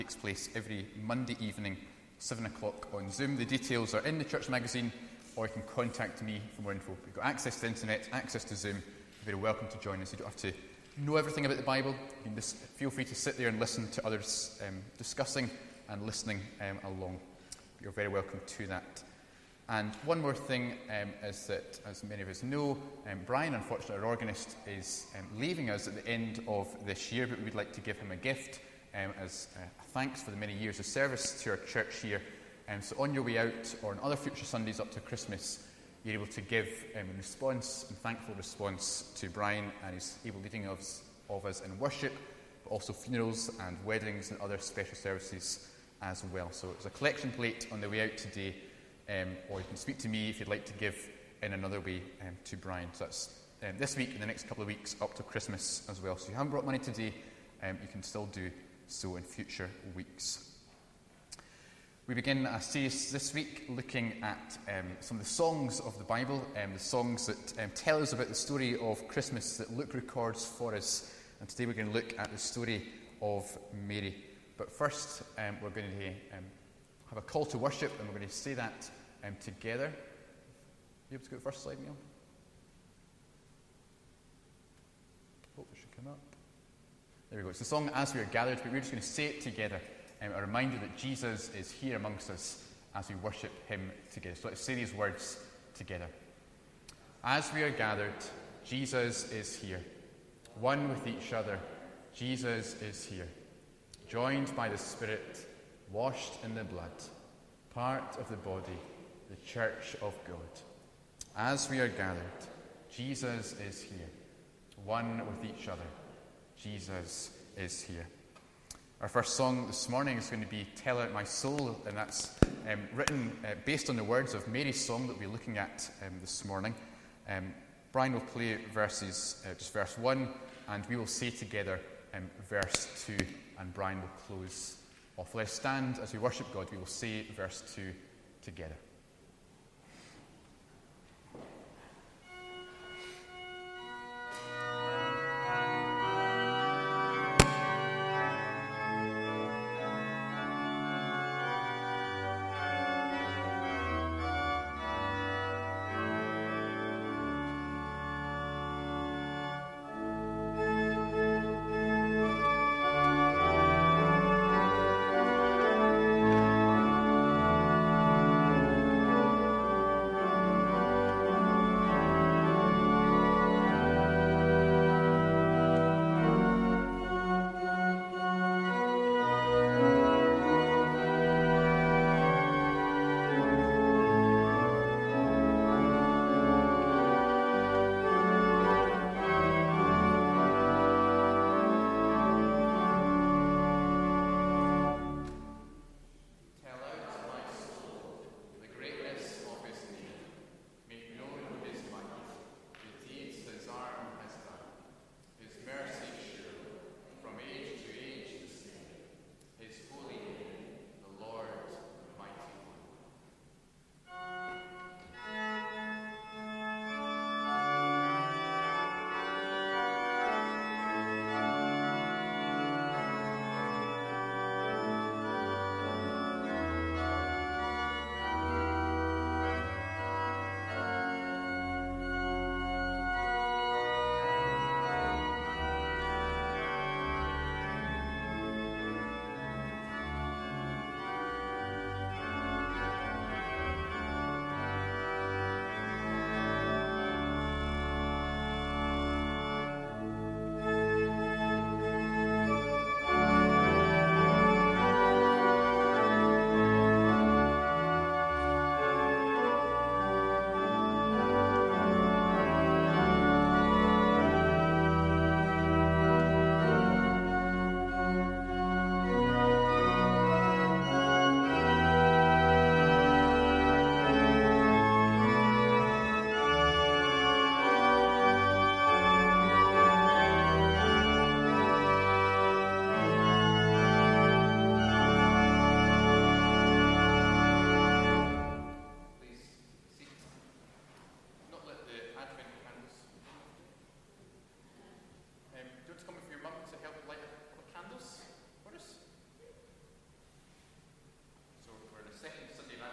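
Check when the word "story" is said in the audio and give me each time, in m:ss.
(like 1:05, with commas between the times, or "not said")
1:08, 1:12.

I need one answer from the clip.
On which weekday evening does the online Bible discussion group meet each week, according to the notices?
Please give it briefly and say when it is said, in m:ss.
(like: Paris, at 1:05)
Monday, at 0:01.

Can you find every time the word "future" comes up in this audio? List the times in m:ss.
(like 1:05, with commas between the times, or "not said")
0:34, 0:59.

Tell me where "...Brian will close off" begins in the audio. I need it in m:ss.
2:13.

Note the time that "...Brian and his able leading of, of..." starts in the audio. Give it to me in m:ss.
0:39.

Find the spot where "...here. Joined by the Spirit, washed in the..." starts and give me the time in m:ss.
1:43.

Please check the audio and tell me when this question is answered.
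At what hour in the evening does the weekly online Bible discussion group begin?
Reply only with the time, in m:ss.
0:02.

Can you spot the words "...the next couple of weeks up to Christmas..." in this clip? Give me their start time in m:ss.
0:54.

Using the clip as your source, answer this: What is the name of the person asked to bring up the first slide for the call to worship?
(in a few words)
Neil.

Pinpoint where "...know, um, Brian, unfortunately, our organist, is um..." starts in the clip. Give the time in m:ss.
0:22.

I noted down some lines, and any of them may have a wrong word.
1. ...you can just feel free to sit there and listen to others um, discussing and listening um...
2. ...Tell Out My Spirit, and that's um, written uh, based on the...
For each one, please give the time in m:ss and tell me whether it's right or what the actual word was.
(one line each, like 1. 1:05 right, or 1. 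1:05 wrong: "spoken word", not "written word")
1. 0:11 right
2. 2:00 wrong: "Soul", not "Spirit".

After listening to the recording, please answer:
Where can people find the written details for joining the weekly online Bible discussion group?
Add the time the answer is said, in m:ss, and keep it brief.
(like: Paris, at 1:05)
The church magazine, at 0:04.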